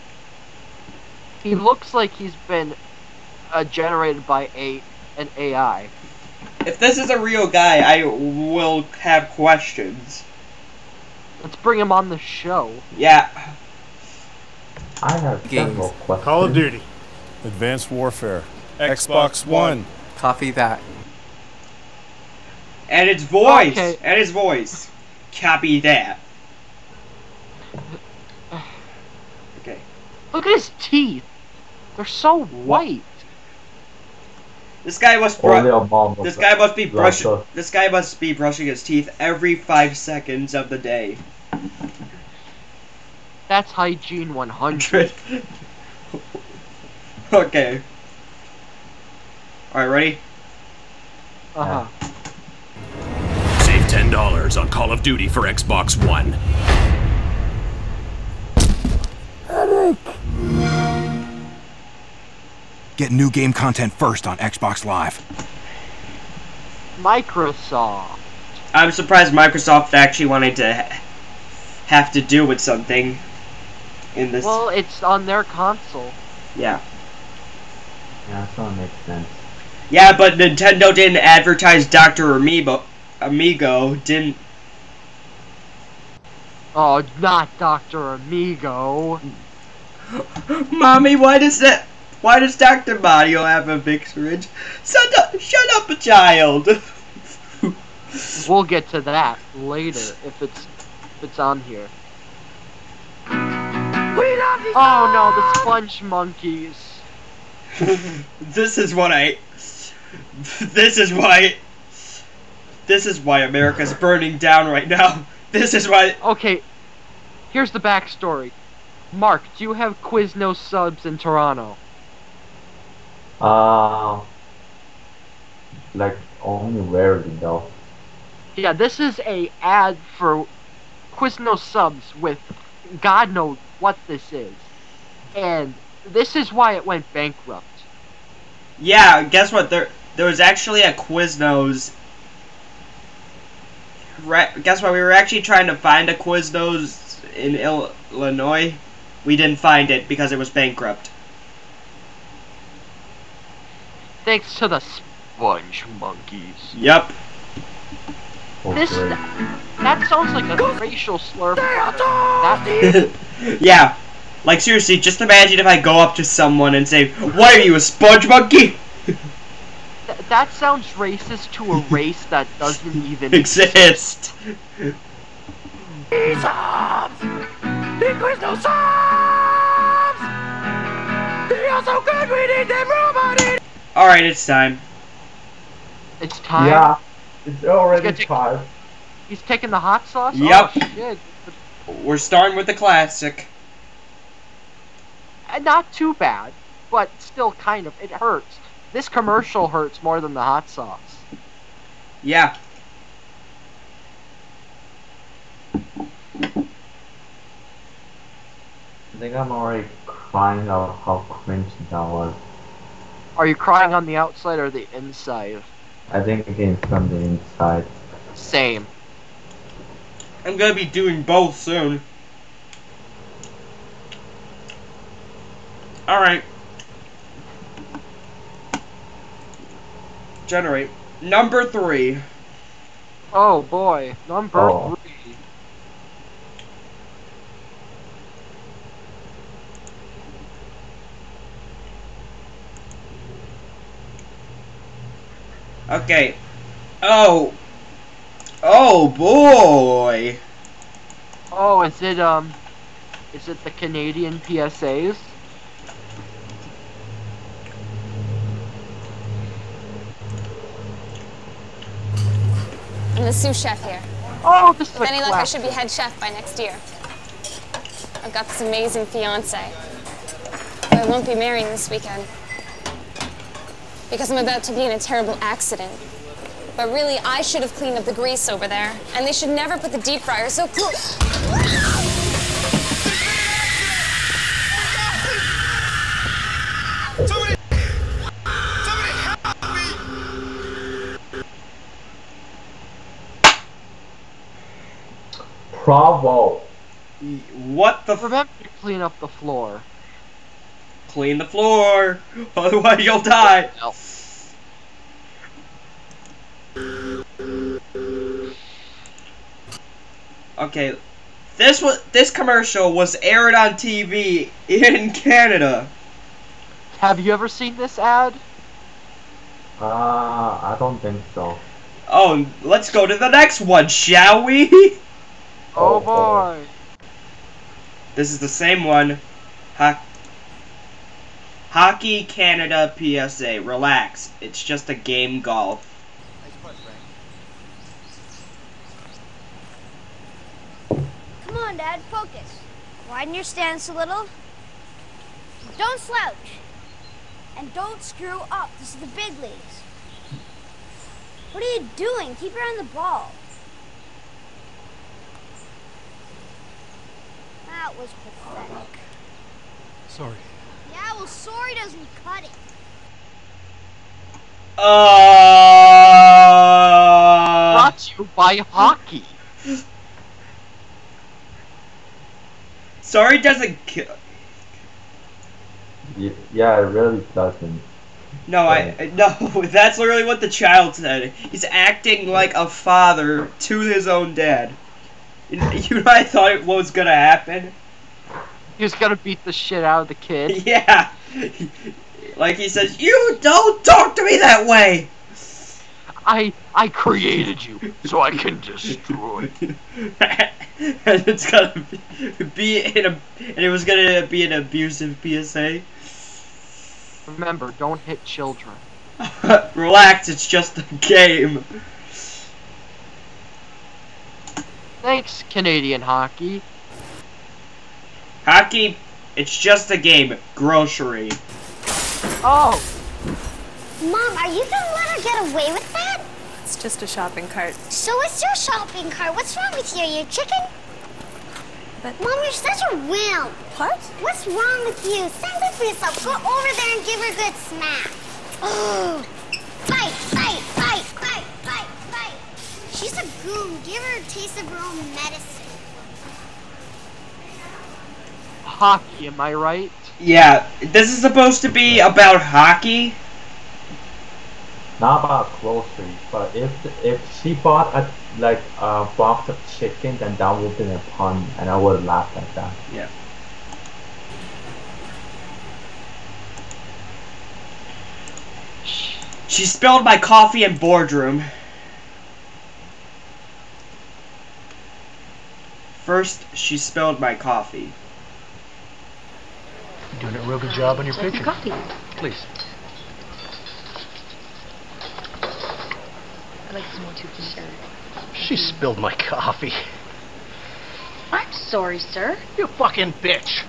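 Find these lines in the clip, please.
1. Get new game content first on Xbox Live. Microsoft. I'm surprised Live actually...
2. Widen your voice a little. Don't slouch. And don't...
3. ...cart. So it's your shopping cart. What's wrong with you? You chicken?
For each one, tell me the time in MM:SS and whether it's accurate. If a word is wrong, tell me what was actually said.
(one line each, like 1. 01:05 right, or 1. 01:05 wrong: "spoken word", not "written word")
1. 01:02 wrong: "Microsoft", not "Live"
2. 05:43 wrong: "stance", not "voice"
3. 07:07 right.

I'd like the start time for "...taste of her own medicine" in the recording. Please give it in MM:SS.
07:24.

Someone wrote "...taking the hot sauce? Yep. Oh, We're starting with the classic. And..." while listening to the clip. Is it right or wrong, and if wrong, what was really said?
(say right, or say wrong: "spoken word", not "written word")
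right.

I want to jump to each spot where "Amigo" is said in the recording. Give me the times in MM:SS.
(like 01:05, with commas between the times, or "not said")
01:23, 01:28.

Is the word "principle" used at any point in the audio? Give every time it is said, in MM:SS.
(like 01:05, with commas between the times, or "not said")
not said.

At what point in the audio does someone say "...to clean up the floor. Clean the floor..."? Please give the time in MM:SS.
04:58.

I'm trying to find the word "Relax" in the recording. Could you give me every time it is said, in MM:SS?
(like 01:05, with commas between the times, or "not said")
05:33, 06:49.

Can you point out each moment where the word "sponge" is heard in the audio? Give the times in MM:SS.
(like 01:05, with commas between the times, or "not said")
01:45, 02:34, 02:47.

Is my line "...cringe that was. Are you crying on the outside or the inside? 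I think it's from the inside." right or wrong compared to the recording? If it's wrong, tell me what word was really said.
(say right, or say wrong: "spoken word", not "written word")
right.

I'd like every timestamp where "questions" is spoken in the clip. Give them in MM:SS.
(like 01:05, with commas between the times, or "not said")
00:09, 00:15.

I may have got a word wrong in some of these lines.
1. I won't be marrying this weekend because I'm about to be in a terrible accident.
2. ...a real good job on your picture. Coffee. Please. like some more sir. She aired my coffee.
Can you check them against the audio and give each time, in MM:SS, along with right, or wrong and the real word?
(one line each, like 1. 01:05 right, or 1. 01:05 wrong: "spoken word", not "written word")
1. 04:30 right
2. 08:00 wrong: "spilled", not "aired".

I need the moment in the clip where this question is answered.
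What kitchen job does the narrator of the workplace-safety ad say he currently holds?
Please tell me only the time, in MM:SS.
04:23.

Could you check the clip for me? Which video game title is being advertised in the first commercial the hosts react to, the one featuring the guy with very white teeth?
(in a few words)
Advanced Warfare.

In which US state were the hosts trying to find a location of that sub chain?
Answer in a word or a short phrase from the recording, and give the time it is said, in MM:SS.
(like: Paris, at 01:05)
Illinois, at 02:27.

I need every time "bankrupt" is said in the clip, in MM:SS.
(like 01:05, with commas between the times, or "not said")
02:17, 02:30.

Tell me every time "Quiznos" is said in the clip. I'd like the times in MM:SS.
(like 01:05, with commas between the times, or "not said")
02:00, 02:11, 02:20, 02:26.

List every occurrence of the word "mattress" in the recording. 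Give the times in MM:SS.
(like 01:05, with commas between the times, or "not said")
not said.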